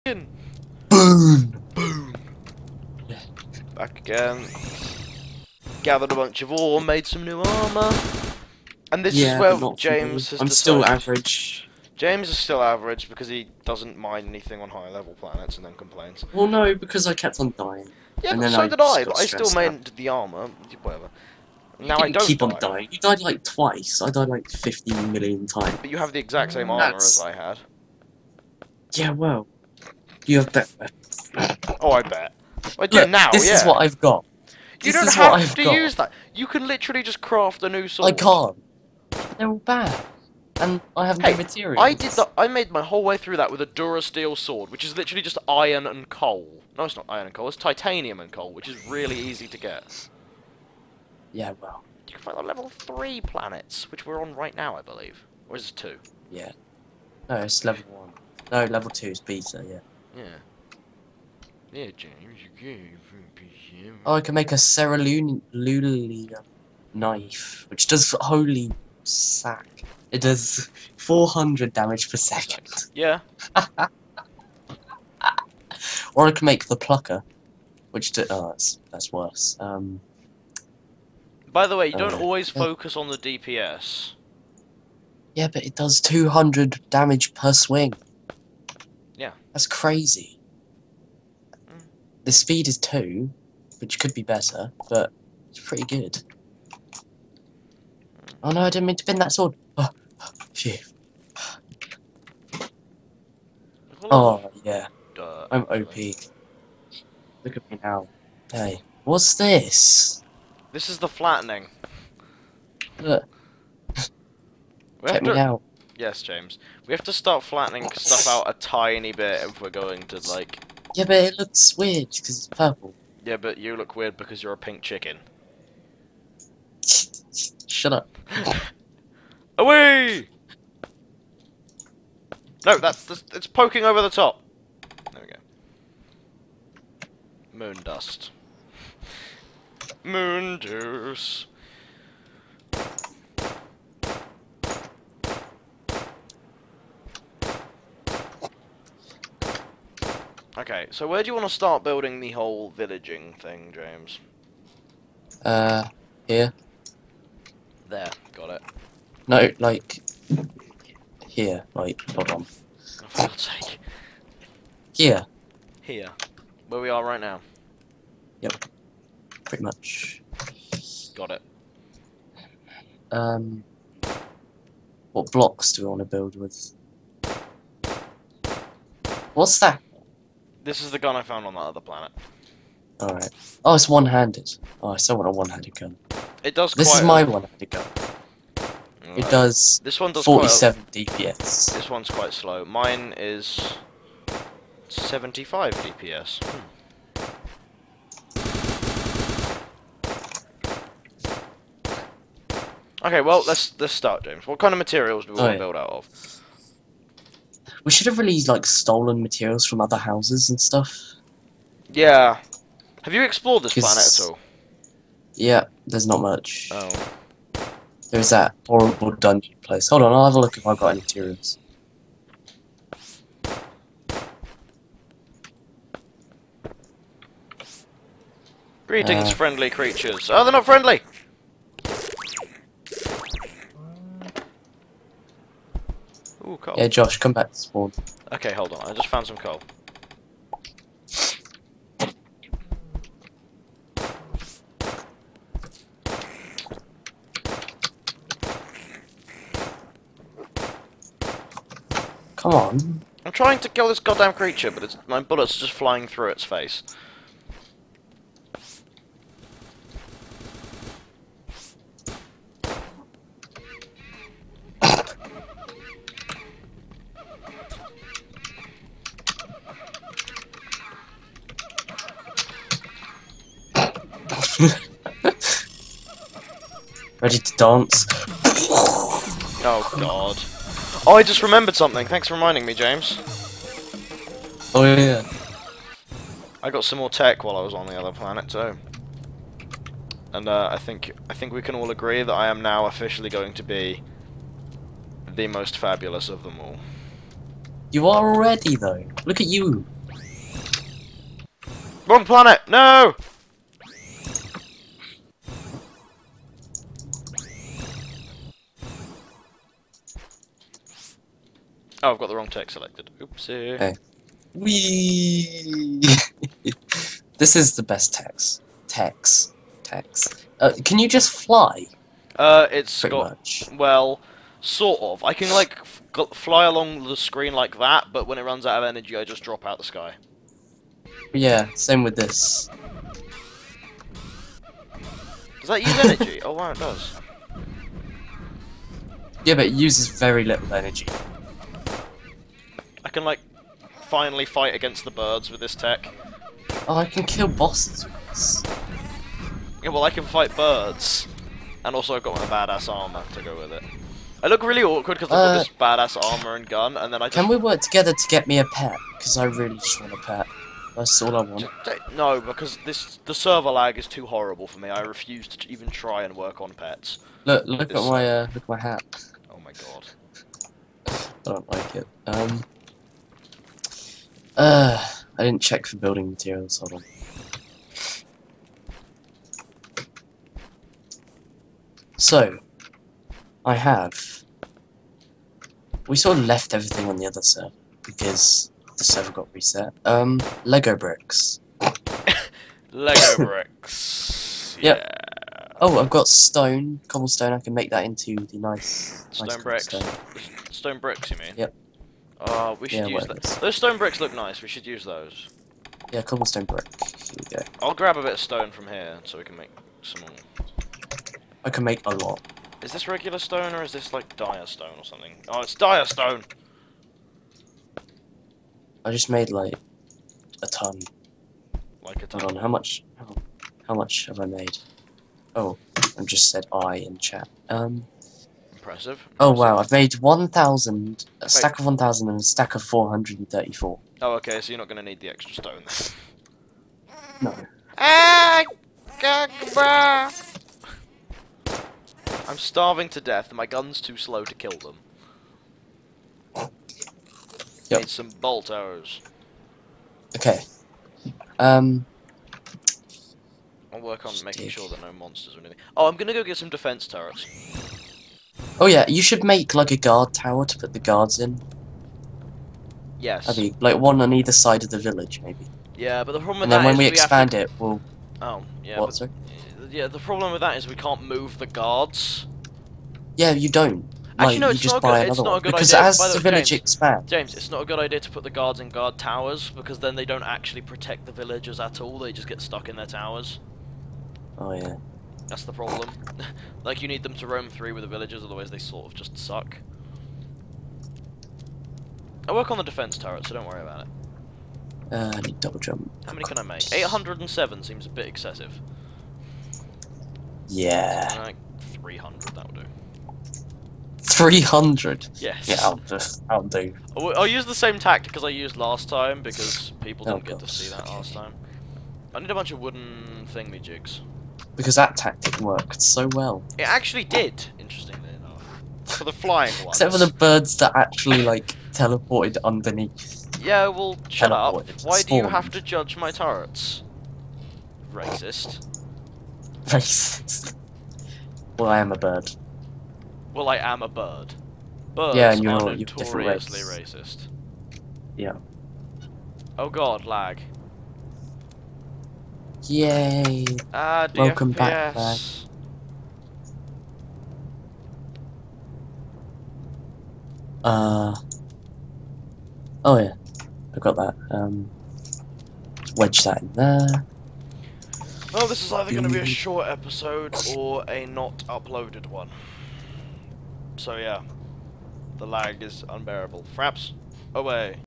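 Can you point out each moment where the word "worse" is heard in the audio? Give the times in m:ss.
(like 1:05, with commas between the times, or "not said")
1:19.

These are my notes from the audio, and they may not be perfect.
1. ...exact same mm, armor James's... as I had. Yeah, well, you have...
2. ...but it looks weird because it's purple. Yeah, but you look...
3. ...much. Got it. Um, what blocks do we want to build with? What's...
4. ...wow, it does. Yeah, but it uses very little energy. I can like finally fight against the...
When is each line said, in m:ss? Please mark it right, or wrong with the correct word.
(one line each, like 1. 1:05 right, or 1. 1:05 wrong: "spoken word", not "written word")
1. 0:26 wrong: "That", not "James"
2. 2:01 right
3. 2:49 right
4. 5:36 right.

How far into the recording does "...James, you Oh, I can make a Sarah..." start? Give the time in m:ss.
1:01.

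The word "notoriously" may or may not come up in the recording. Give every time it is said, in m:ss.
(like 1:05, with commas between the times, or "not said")
8:55.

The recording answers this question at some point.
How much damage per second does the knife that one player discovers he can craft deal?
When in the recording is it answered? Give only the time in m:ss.
1:10.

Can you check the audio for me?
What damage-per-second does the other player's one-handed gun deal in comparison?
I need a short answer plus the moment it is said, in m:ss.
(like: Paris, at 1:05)
75, at 3:14.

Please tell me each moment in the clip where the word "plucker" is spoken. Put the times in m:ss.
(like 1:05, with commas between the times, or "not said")
1:16.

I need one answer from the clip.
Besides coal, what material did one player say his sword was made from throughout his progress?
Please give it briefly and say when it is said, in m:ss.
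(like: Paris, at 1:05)
Titanium, at 0:47.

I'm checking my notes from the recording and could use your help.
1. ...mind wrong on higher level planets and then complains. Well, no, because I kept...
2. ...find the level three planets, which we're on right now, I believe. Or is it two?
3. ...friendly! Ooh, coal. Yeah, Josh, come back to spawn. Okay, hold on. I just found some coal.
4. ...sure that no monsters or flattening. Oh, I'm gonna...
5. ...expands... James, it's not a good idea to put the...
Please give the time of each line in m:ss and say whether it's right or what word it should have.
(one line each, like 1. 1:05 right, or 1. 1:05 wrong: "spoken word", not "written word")
1. 0:13 wrong: "anything", not "wrong"
2. 0:52 right
3. 3:50 right
4. 7:34 wrong: "anything", not "flattening"
5. 7:56 right.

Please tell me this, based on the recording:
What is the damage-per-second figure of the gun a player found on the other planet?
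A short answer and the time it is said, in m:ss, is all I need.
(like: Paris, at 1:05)
47, at 3:10.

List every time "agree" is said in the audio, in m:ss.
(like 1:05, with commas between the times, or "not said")
4:51.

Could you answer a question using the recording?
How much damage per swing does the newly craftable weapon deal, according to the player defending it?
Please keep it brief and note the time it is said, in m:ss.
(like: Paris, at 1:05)
200, at 1:26.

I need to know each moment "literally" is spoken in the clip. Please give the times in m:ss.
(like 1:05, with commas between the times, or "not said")
0:36, 0:44.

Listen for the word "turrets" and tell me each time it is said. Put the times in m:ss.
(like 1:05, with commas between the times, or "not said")
7:37, 8:13, 8:46.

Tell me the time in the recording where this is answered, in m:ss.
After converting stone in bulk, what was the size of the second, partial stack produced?
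7:12.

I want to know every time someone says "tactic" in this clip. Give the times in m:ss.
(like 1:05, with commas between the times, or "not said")
8:27, 8:35.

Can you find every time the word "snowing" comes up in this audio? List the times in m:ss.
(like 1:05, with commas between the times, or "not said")
not said.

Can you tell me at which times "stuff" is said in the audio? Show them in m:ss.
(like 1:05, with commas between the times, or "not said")
1:57, 3:30.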